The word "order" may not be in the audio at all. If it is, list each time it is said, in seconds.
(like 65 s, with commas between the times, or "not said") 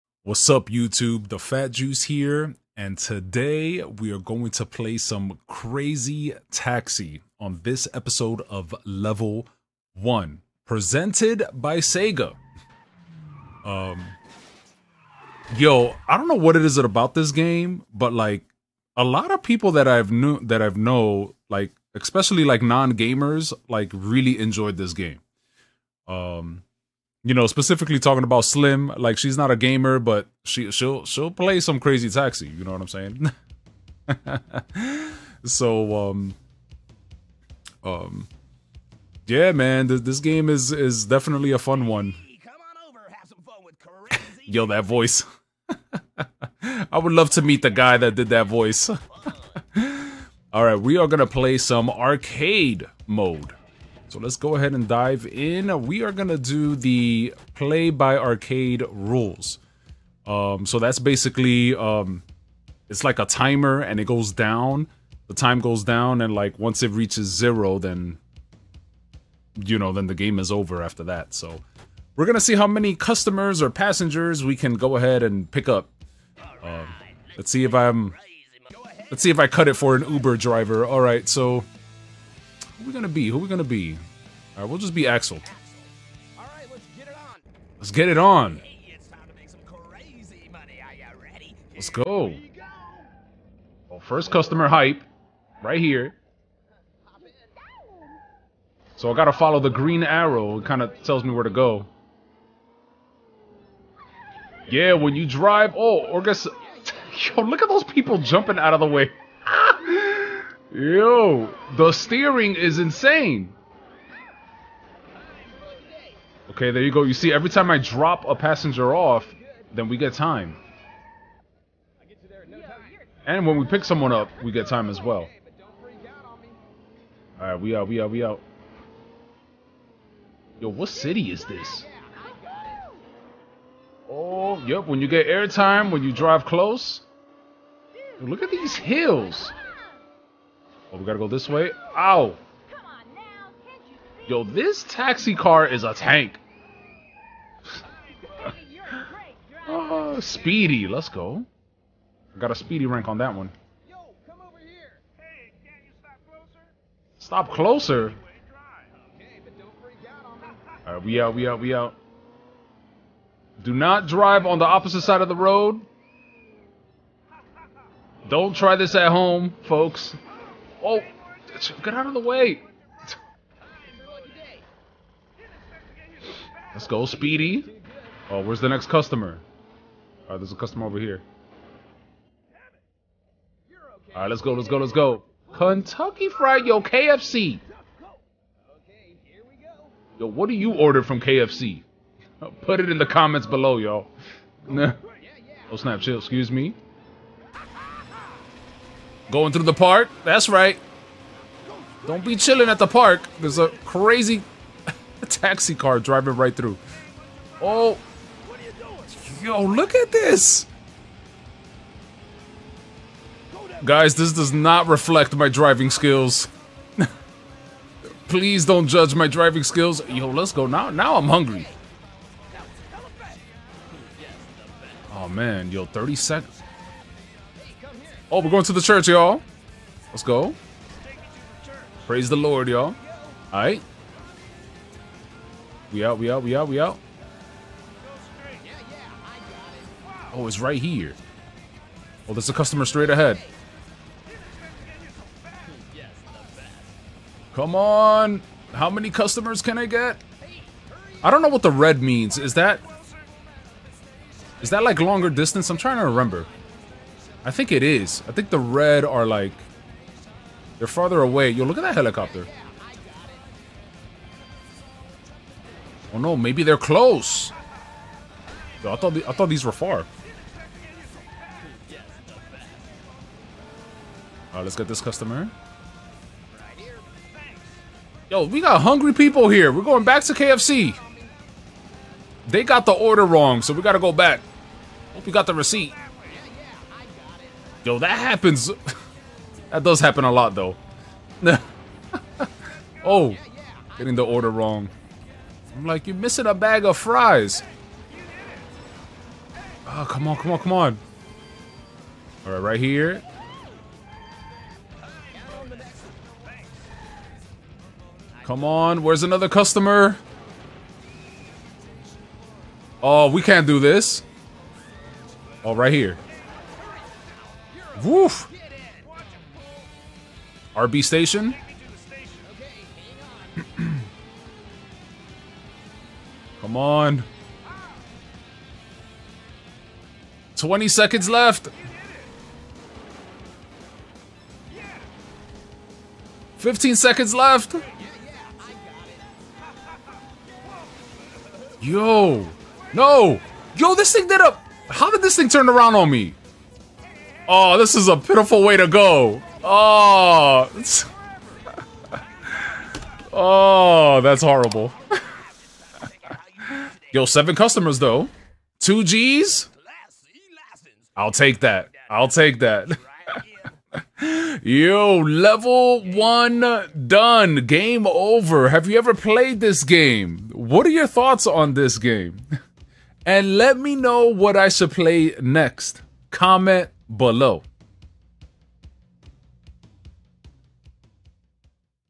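190 s, 282 s, 294 s.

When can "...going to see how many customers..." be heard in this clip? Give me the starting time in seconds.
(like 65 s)
72 s.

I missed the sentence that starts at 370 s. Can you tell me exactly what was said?
What are your thoughts on this game?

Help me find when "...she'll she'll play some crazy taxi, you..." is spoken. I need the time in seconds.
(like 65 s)
30 s.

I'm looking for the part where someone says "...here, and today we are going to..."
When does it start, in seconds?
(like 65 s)
2 s.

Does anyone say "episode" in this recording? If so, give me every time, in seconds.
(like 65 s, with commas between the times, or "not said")
7 s.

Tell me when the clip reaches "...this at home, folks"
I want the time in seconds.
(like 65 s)
168 s.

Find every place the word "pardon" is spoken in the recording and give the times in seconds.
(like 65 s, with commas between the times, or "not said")
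not said.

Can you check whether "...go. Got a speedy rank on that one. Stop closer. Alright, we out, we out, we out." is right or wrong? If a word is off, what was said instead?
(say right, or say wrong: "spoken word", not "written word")
right.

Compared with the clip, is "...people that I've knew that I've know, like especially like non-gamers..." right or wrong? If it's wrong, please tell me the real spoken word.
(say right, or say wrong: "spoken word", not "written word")
right.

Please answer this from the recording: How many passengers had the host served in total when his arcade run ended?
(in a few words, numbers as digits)
7.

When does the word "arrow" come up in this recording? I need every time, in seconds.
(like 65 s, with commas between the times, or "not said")
100 s.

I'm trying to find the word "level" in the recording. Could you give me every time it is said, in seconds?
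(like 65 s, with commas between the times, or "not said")
8 s, 365 s.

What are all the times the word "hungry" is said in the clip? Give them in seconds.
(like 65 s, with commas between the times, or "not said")
221 s, 278 s.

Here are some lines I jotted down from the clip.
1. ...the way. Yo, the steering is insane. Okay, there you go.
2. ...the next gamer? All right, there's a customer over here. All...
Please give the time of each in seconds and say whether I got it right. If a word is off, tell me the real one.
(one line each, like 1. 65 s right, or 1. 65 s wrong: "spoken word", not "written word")
1. 108 s right
2. 178 s wrong: "customer", not "gamer".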